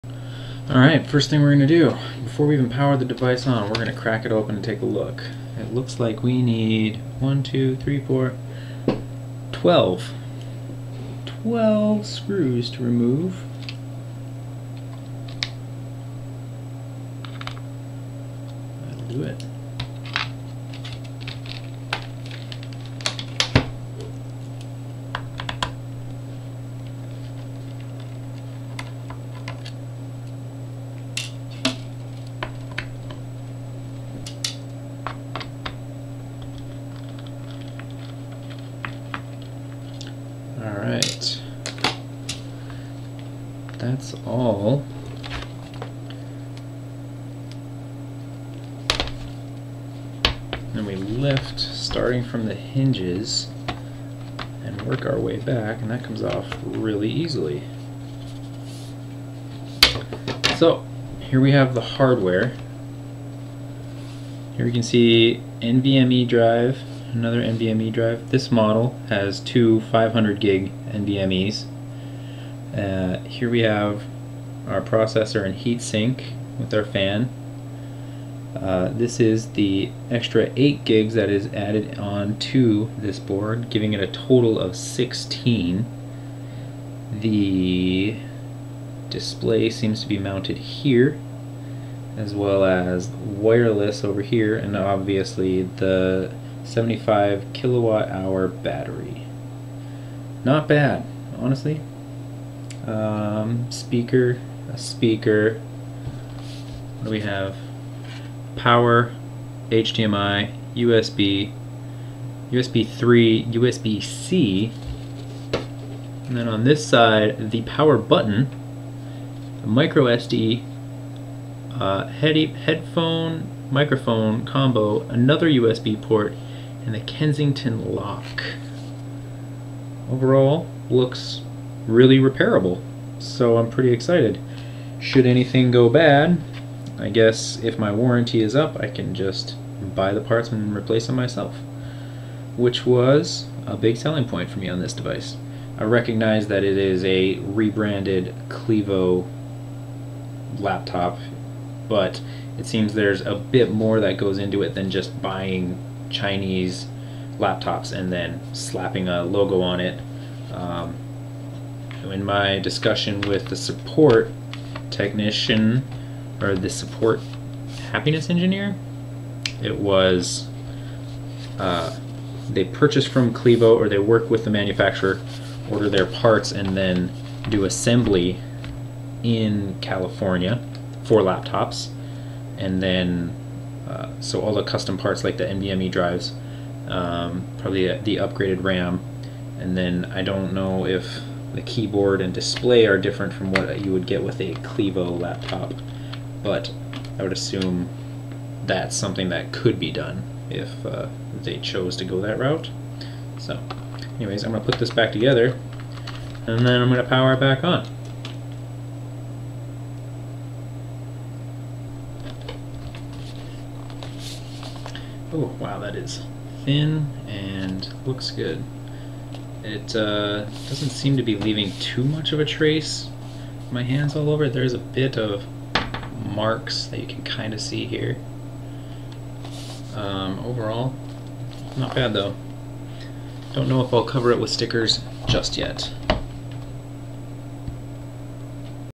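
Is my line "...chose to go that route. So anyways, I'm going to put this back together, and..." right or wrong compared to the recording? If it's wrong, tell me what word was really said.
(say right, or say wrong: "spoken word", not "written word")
right.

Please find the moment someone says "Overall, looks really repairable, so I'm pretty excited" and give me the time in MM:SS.
02:10.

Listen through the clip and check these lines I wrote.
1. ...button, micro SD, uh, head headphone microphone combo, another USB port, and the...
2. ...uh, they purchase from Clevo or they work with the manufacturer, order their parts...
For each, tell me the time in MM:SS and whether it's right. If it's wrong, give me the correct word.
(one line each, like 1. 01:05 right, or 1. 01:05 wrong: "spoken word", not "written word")
1. 01:57 right
2. 02:51 right.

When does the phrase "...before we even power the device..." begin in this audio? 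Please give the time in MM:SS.
00:02.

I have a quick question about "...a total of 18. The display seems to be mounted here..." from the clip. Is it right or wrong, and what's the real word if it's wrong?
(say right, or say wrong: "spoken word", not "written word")
wrong: "16", not "18".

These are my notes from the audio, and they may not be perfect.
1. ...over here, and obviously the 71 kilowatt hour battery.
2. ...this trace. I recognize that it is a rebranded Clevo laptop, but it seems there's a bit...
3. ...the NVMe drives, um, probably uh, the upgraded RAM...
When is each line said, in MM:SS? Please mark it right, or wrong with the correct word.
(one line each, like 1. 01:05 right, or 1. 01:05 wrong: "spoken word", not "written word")
1. 01:34 wrong: "75", not "71"
2. 02:24 wrong: "device", not "trace"
3. 03:05 right.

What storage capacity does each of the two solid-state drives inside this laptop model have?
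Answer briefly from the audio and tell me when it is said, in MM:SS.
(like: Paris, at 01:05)
500 GB, at 01:09.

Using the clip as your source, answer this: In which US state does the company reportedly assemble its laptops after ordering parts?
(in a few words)
California.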